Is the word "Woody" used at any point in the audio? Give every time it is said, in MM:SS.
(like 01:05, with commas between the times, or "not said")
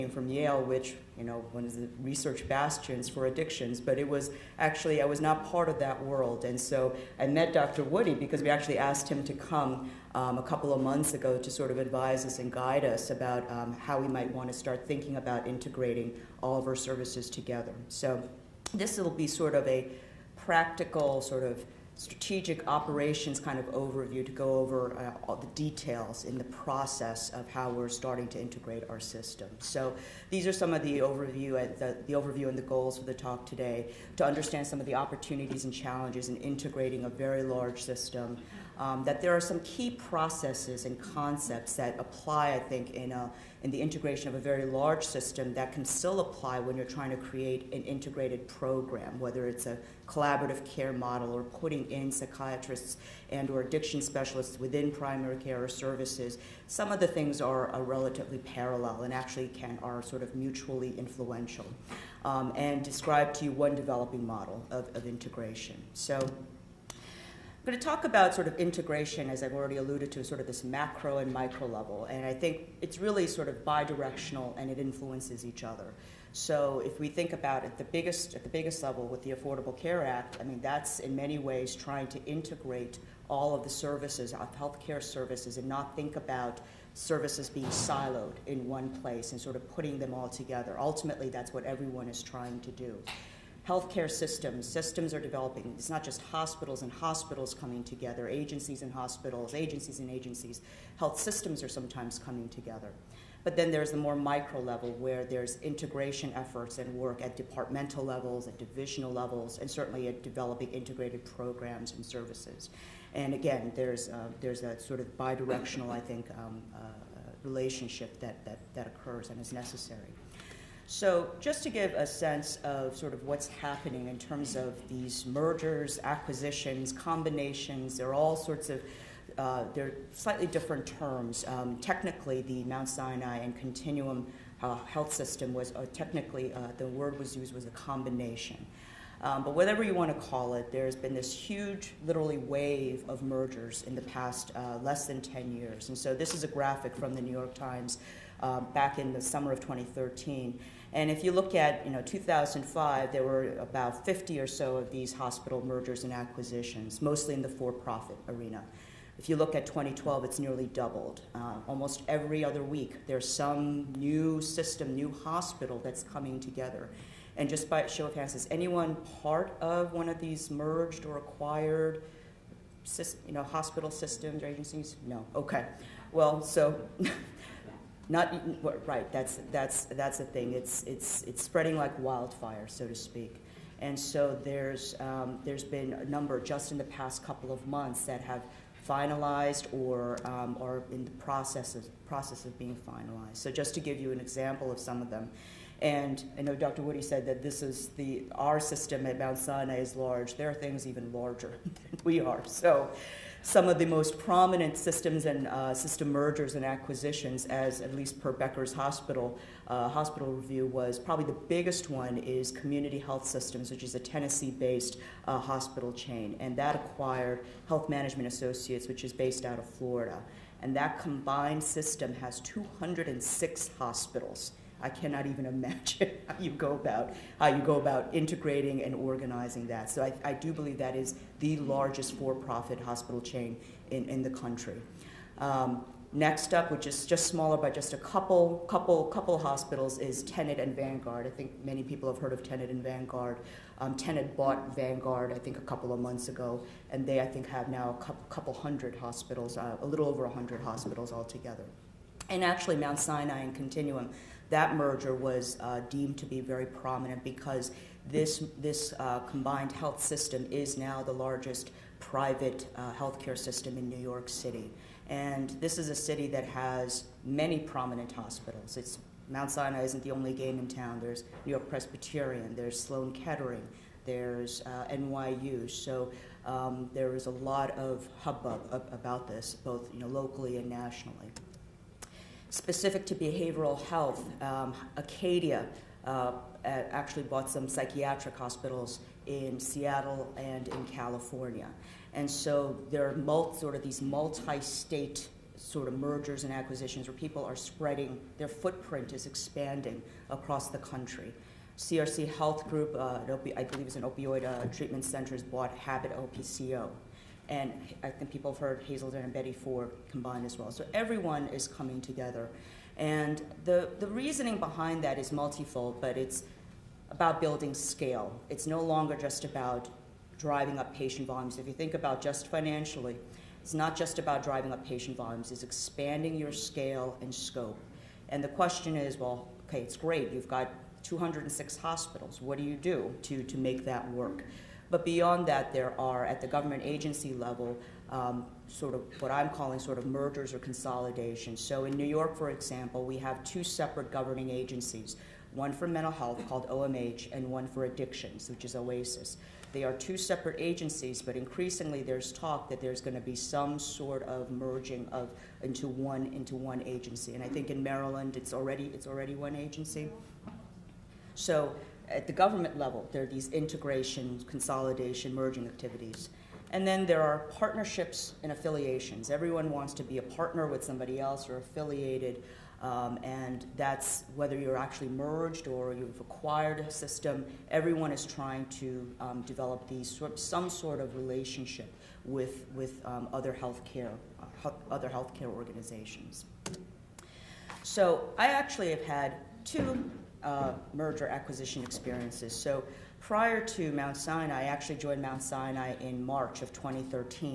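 00:07, 03:16.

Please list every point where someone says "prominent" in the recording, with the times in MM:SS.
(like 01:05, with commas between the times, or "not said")
03:24, 04:16, 04:27.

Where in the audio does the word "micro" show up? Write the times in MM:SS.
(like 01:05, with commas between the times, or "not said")
01:11, 01:44.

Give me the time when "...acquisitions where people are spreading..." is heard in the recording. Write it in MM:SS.
04:56.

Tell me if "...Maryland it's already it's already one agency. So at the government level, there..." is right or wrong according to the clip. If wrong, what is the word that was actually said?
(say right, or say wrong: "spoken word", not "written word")
right.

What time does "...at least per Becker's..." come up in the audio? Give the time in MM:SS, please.
03:27.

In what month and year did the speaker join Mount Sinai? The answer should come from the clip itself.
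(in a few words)
March 2013.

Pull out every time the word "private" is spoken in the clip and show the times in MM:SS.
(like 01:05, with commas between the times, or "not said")
04:21.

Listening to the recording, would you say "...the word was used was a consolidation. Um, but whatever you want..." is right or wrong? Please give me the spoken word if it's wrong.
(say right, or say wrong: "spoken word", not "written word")
wrong: "combination", not "consolidation".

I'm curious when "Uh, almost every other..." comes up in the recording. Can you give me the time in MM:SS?
02:41.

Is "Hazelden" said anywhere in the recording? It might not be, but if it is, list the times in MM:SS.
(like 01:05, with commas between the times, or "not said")
05:08.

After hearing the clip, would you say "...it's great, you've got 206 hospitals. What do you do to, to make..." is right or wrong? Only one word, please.
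right.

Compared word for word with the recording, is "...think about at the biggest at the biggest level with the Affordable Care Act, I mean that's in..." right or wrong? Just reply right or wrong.
right.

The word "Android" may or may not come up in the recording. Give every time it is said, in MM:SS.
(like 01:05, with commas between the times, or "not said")
not said.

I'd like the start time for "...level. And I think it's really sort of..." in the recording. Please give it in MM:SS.
01:11.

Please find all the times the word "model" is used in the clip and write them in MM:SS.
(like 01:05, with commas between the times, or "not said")
00:50, 01:04.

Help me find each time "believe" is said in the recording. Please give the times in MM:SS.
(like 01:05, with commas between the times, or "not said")
03:50, 05:03.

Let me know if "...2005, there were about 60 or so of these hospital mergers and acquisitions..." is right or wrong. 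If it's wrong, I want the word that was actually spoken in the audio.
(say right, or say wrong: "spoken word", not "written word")
wrong: "50", not "60".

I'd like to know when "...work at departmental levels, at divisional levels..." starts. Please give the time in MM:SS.
01:46.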